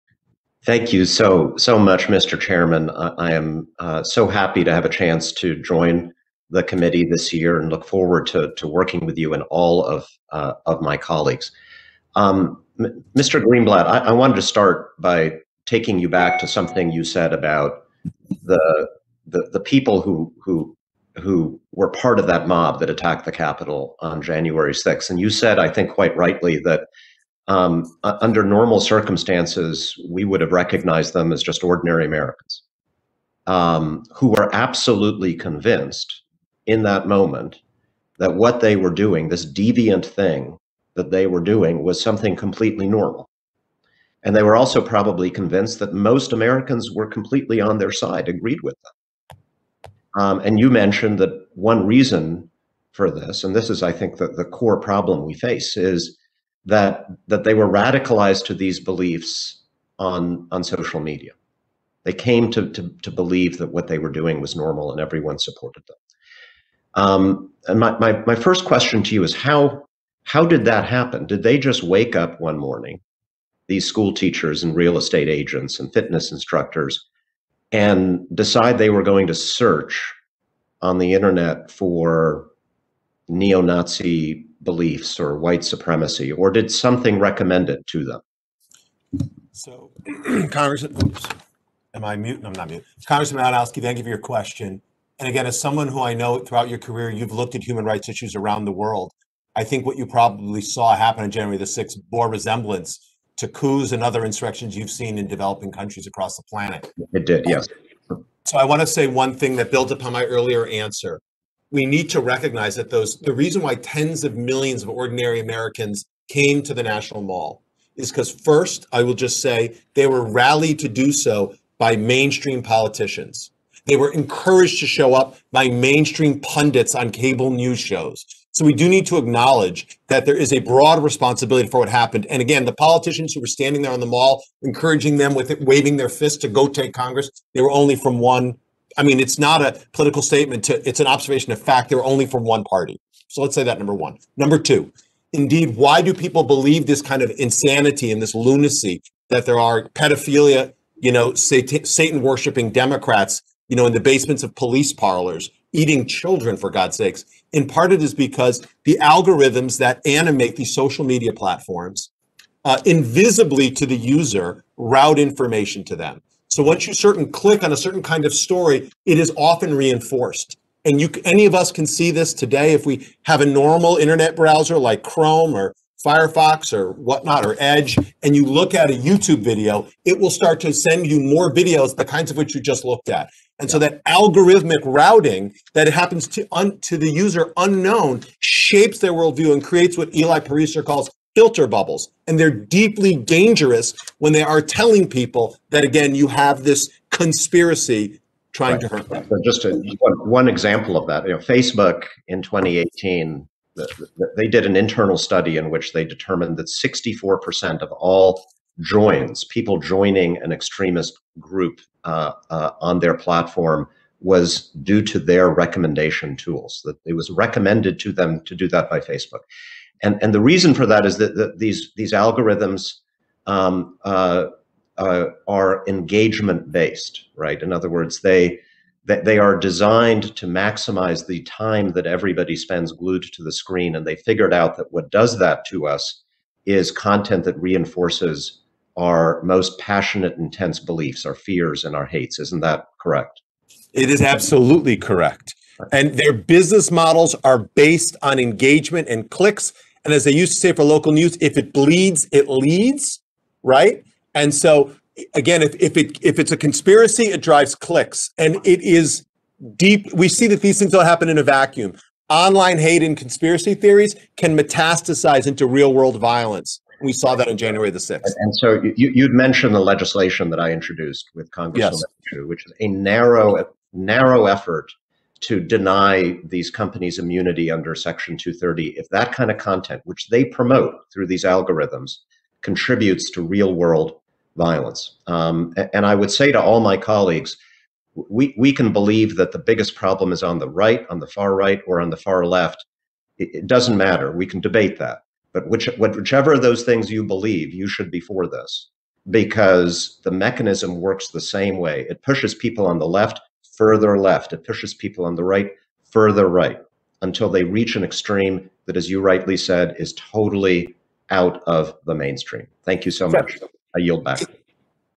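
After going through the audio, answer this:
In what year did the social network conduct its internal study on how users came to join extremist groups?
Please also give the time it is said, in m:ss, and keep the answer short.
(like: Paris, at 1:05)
2018, at 3:22.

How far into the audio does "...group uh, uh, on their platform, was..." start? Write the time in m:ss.
3:31.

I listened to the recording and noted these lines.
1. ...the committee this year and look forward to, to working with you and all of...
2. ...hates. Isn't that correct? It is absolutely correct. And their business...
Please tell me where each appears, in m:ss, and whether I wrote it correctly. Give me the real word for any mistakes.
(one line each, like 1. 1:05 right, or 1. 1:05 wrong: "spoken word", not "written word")
1. 0:06 right
2. 4:02 right.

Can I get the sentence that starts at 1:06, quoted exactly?
Um, and my, my my first question to you is how how did that happen?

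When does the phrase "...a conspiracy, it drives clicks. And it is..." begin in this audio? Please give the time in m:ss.
4:16.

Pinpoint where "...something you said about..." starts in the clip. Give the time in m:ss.
0:16.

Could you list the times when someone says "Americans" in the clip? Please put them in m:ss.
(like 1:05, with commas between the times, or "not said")
0:32, 0:46, 1:55.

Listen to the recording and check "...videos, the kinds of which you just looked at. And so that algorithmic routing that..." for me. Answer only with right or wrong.
right.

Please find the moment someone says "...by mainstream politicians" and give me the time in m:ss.
2:01.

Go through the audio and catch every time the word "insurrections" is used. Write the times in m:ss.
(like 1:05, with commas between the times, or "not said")
1:44.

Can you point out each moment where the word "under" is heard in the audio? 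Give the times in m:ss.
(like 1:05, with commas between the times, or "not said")
0:28, 4:37.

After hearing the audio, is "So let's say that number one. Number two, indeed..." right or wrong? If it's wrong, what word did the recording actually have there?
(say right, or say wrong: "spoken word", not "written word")
right.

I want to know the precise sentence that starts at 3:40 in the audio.
And, and the reason for that is that, that these, these algorithms um, uh, uh, are engagement based, right?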